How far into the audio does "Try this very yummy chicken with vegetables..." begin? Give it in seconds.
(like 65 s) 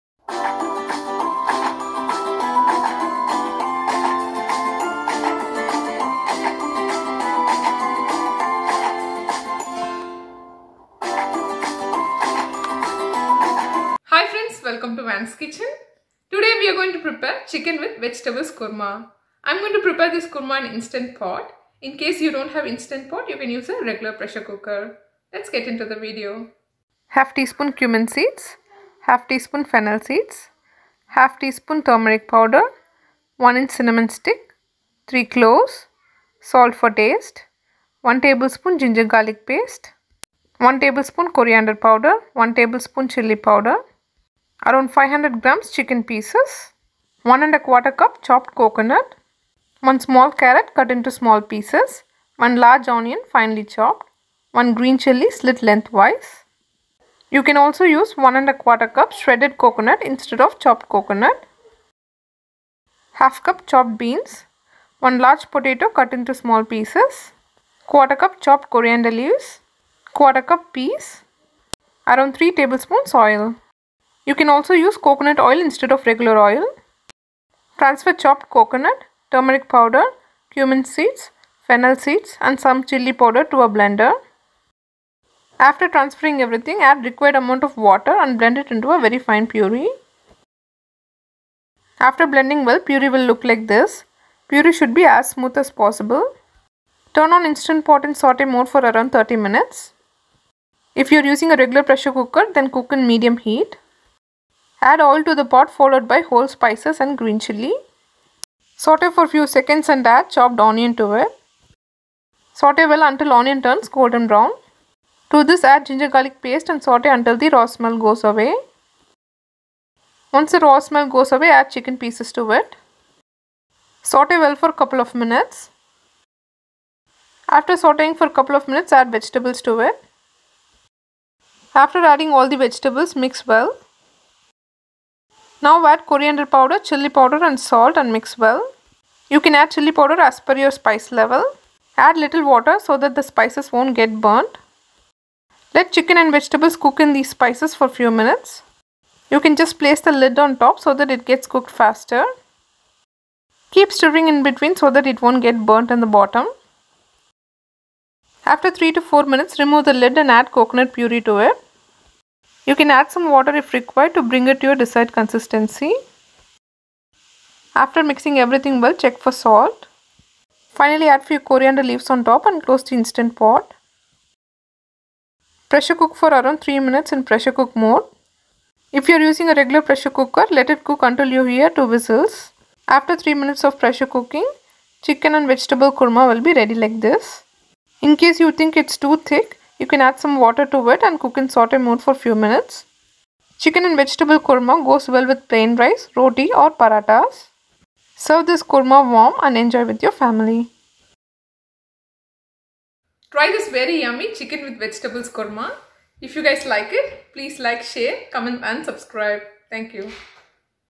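203 s.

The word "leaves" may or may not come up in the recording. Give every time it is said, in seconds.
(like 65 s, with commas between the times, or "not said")
69 s, 171 s.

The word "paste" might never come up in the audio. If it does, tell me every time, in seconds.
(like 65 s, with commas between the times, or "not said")
39 s, 116 s.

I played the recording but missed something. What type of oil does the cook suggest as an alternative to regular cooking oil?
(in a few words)
coconut oil.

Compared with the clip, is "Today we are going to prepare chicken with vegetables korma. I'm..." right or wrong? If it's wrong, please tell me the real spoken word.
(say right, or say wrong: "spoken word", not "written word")
right.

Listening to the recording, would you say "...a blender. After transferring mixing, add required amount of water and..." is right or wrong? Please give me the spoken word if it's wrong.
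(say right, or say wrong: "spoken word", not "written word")
wrong: "everything", not "mixing".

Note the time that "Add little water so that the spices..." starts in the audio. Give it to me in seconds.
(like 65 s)
141 s.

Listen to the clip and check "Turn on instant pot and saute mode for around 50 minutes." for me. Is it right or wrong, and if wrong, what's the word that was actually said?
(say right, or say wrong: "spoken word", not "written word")
wrong: "30", not "50".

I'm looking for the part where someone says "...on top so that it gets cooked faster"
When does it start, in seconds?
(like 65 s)
150 s.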